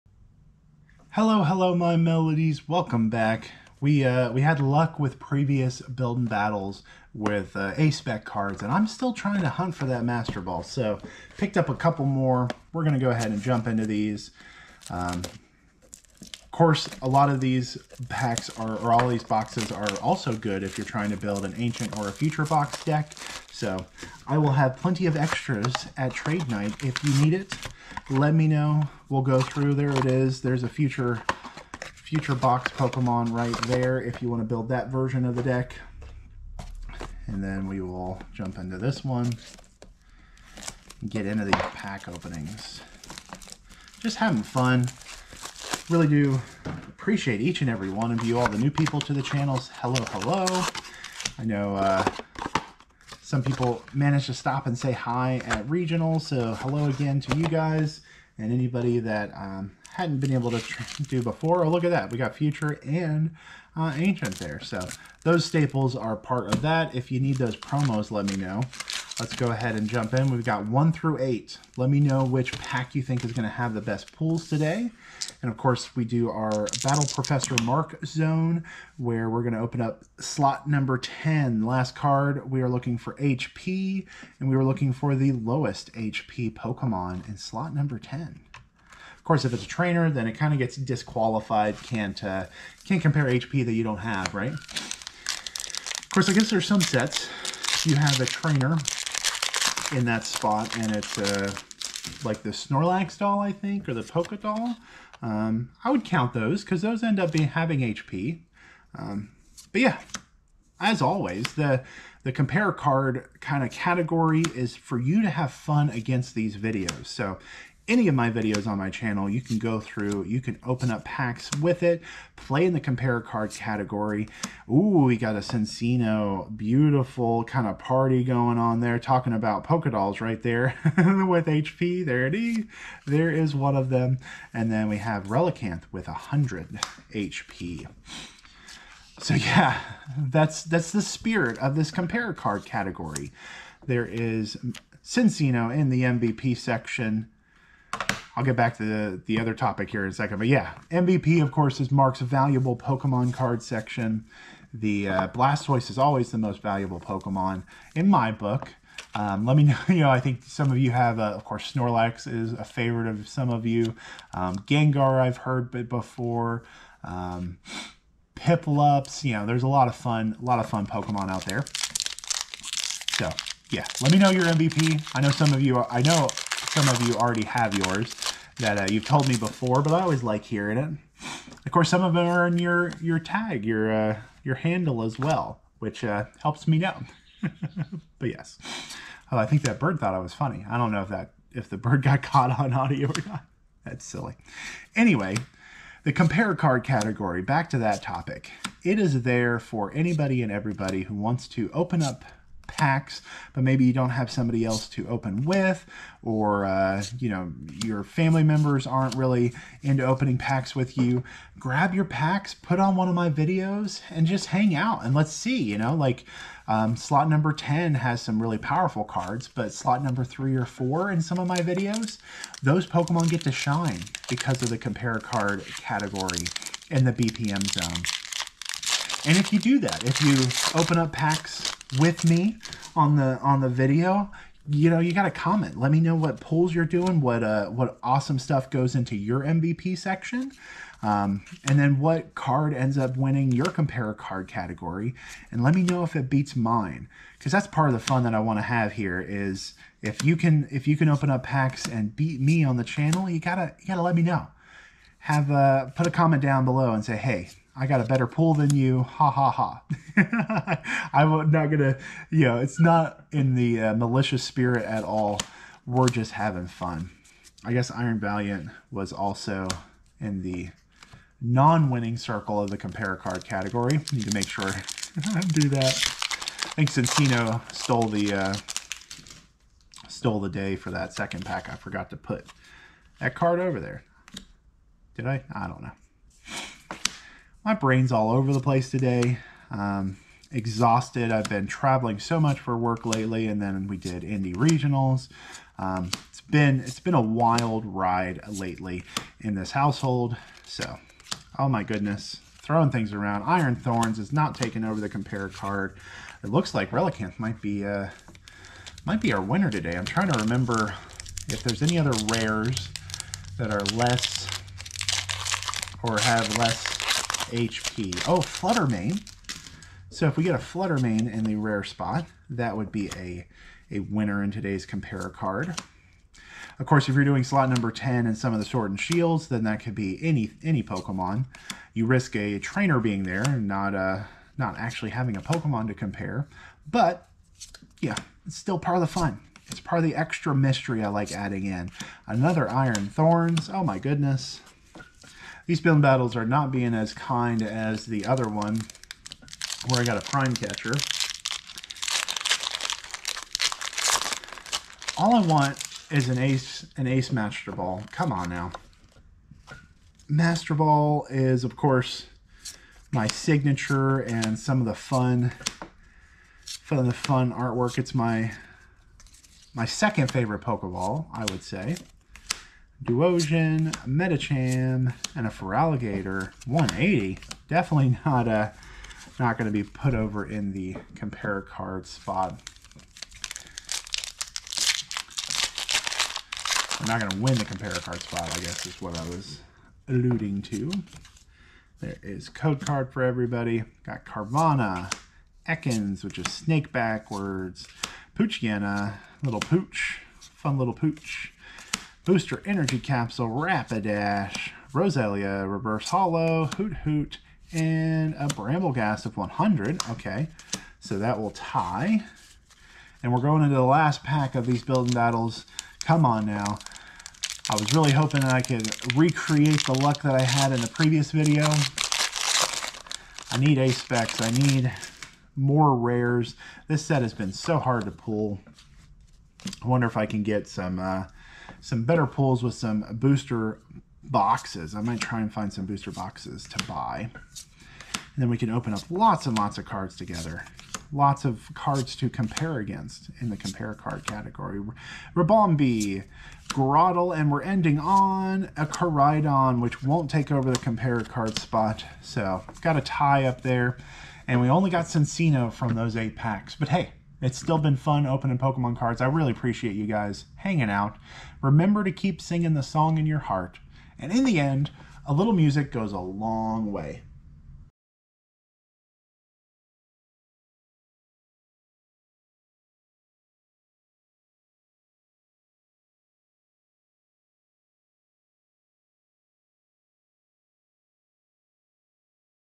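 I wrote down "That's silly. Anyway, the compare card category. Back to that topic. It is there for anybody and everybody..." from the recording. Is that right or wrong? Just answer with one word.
right.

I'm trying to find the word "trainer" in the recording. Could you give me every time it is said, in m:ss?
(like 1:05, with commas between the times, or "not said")
1:29, 1:38, 5:32.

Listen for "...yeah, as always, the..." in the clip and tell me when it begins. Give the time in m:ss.
1:49.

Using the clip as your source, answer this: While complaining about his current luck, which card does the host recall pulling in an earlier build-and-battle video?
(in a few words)
Prime Catcher.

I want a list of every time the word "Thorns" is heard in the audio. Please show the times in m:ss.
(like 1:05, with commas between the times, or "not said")
5:03, 5:43.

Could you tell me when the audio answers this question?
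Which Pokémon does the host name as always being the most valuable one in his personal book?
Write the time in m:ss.
2:35.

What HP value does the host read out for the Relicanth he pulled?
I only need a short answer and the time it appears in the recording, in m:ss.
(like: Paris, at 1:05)
100, at 2:16.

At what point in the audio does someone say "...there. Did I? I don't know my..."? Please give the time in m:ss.
4:43.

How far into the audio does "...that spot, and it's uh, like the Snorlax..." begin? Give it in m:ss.
1:40.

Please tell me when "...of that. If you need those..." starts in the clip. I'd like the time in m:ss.
1:06.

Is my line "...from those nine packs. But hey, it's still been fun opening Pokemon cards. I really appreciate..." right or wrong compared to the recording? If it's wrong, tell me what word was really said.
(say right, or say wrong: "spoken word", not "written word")
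wrong: "eight", not "nine".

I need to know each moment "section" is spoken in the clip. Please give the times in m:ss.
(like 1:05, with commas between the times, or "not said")
2:26, 2:33, 3:59.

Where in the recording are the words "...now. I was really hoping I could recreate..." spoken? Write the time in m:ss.
6:56.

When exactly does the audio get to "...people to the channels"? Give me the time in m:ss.
0:48.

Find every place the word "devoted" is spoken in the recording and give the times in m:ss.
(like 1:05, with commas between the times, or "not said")
not said.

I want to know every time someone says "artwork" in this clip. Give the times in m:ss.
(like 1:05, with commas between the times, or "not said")
6:07.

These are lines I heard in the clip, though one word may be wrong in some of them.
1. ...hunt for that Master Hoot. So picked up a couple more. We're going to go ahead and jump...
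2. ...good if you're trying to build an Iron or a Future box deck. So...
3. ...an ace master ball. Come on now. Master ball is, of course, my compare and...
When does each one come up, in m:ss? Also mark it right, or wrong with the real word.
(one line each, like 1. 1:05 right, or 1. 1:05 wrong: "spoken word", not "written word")
1. 0:09 wrong: "Ball", not "Hoot"
2. 0:20 wrong: "Ancient", not "Iron"
3. 5:56 wrong: "signature", not "compare".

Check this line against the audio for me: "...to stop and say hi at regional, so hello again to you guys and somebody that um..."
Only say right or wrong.
wrong.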